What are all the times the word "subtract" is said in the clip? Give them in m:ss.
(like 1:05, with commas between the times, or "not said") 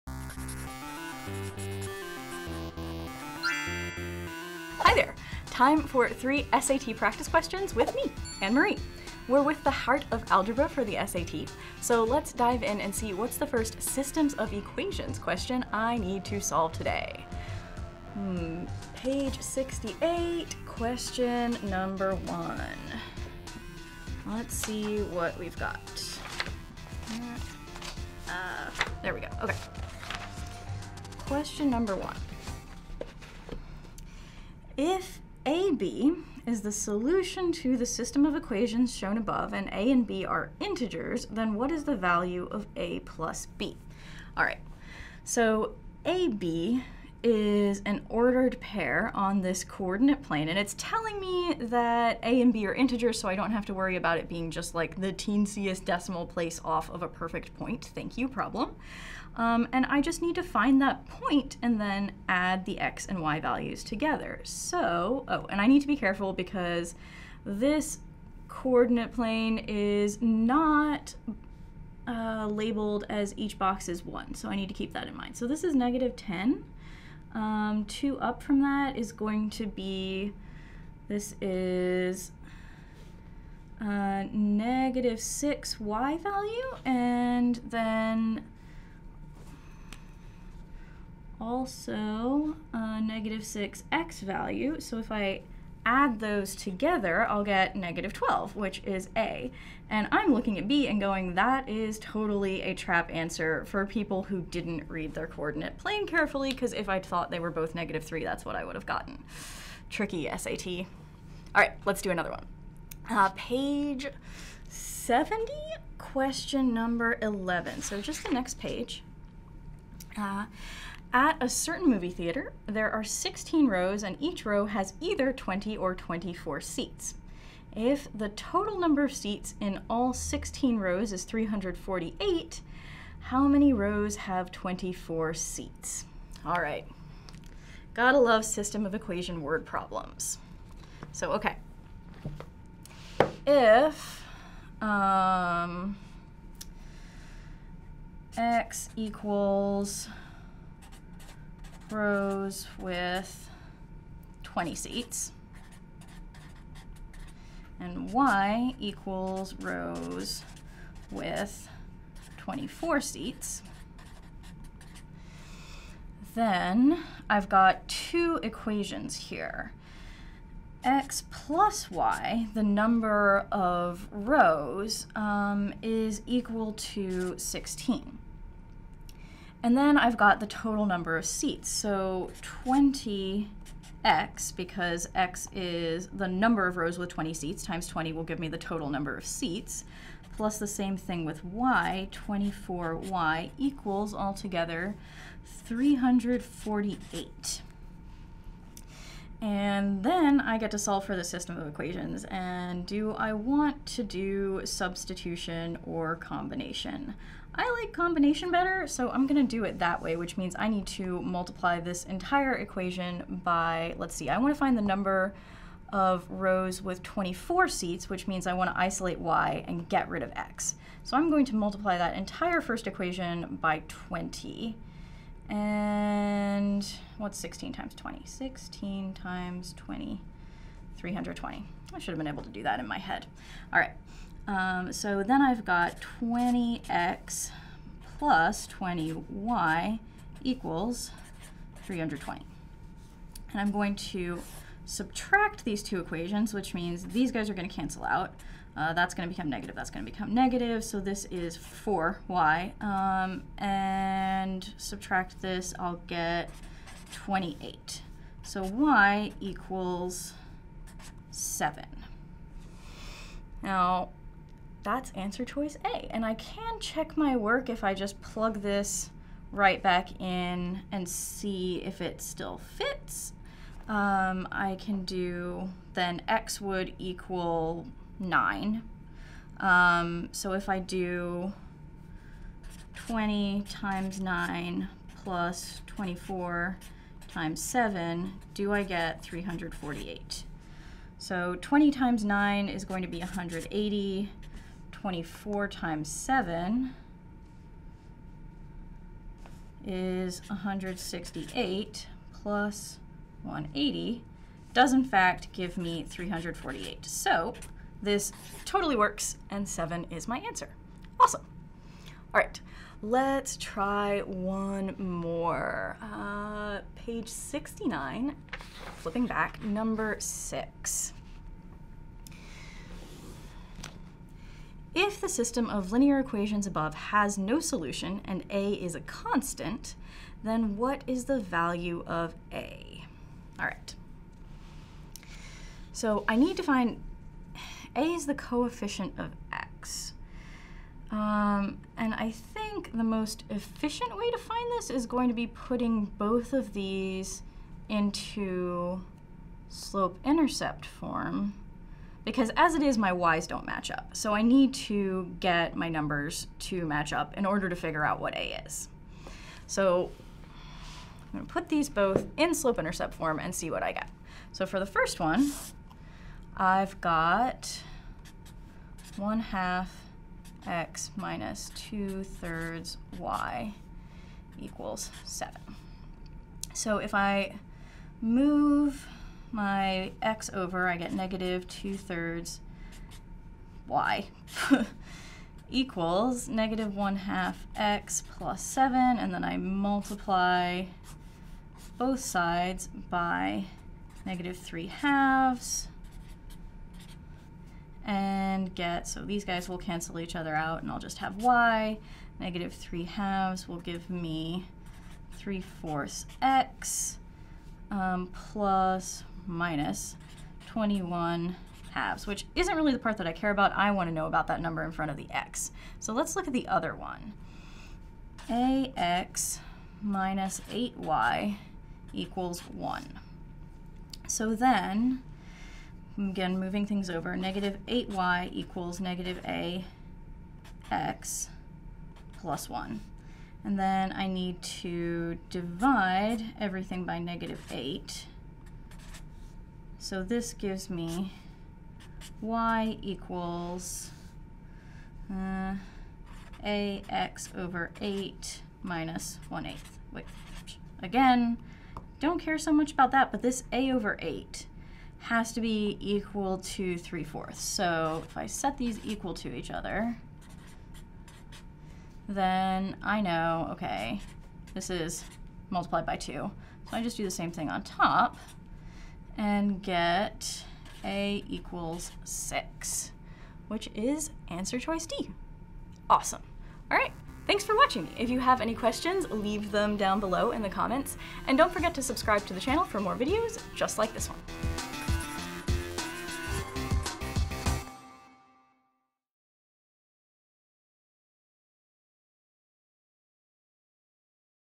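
4:04, 4:14.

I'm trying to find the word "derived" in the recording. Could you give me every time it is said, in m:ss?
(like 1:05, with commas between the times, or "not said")
not said.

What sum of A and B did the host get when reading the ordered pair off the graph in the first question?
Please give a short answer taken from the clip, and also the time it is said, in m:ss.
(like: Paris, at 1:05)
-12, at 1:37.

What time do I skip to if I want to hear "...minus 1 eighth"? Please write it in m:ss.
7:28.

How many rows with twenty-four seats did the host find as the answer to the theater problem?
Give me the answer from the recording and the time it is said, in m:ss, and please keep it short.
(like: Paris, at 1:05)
7, at 5:09.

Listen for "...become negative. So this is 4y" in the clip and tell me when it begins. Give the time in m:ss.
4:10.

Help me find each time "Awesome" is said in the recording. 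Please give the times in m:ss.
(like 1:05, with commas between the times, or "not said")
5:11, 7:56.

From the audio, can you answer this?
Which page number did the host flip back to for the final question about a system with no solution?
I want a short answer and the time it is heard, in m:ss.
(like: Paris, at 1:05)
69, at 5:16.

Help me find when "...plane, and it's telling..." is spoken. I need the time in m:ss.
0:50.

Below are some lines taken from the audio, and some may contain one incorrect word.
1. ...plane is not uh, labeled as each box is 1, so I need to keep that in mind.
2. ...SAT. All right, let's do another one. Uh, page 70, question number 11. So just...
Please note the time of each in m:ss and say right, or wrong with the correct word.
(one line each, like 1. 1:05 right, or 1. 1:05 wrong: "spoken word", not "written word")
1. 1:09 right
2. 1:50 right.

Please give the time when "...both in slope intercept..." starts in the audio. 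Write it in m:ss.
6:01.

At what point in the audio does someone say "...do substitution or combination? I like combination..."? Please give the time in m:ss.
3:24.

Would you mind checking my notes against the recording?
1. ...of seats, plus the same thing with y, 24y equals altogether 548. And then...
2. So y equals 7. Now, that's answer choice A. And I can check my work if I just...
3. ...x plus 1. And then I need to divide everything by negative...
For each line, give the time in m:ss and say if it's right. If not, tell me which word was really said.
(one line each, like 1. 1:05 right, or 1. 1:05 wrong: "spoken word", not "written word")
1. 3:09 wrong: "348", not "548"
2. 4:18 right
3. 7:10 right.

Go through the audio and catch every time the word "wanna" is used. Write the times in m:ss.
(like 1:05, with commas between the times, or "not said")
3:34, 3:38.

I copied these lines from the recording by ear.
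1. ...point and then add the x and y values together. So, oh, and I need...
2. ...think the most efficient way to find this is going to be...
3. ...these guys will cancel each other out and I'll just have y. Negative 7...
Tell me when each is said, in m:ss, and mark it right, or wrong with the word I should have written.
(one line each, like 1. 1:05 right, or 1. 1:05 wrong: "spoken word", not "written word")
1. 1:01 right
2. 5:42 right
3. 6:39 wrong: "3", not "7".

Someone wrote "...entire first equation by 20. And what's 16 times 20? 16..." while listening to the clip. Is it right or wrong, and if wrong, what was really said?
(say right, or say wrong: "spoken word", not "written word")
right.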